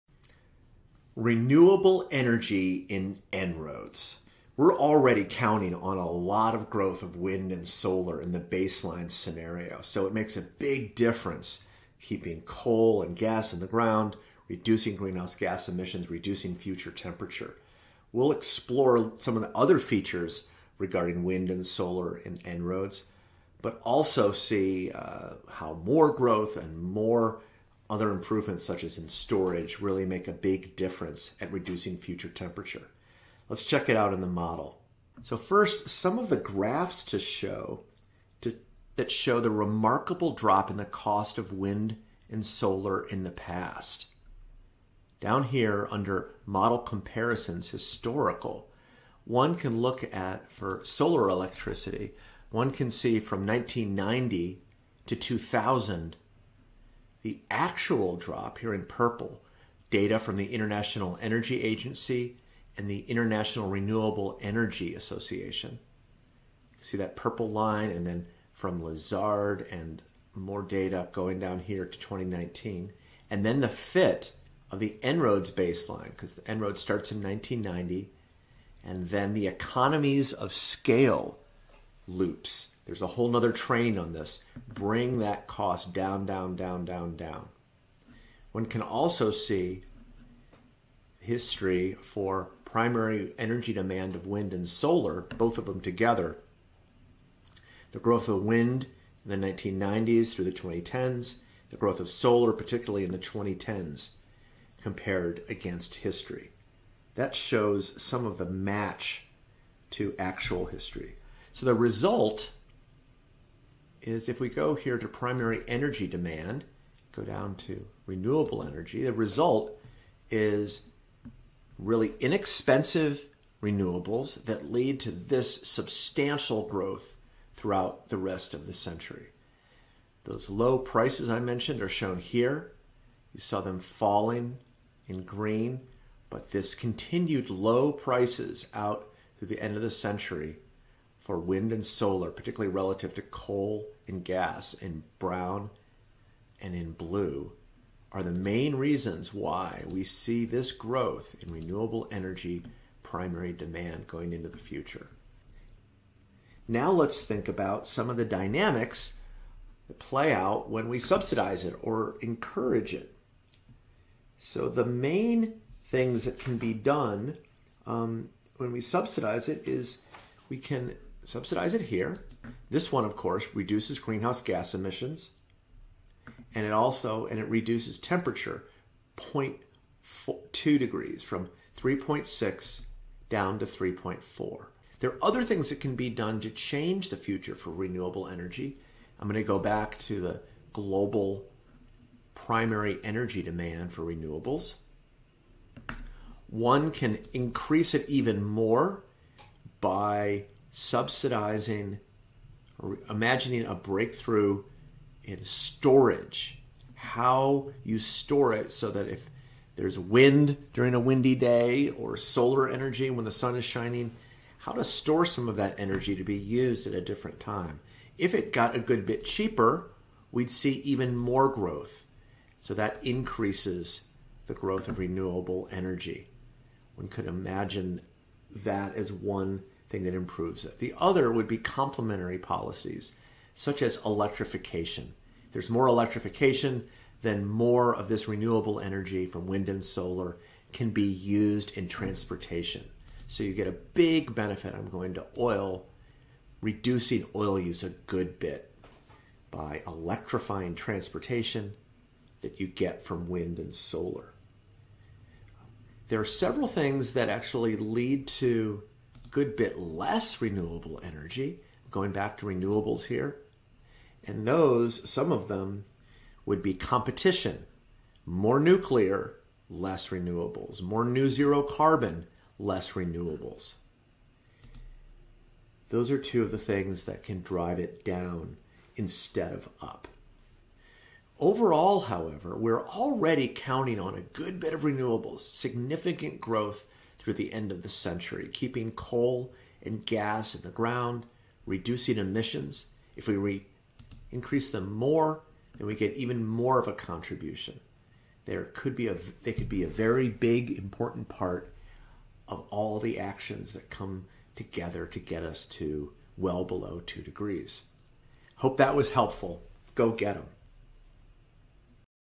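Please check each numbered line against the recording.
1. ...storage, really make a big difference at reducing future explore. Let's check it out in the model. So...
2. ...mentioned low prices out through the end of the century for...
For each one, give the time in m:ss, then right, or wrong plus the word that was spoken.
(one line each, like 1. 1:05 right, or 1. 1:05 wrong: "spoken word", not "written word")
1. 0:29 wrong: "temperature", not "explore"
2. 2:16 wrong: "continued", not "mentioned".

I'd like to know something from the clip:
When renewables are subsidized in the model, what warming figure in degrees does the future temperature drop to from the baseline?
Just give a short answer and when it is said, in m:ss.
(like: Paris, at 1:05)
3.4, at 3:03.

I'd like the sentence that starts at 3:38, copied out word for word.
If it got a good bit cheaper, we'd see even more growth.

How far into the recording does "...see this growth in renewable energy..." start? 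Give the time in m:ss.
2:30.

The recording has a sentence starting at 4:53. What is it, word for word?
If we increase them more, then we get even more of a contribution.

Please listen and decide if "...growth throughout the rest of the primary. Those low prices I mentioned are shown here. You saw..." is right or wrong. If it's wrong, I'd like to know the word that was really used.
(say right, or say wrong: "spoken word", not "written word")
wrong: "century", not "primary".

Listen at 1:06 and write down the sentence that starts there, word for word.
See that purple line and then from Lazard and more data going down here to 2019.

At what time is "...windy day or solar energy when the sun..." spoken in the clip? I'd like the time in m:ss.
3:30.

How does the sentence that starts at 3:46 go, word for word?
One could imagine that as one thing that improves it.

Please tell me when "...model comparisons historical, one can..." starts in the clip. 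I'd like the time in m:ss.
0:46.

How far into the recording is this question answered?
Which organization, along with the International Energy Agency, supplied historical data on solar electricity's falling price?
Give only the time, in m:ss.
1:03.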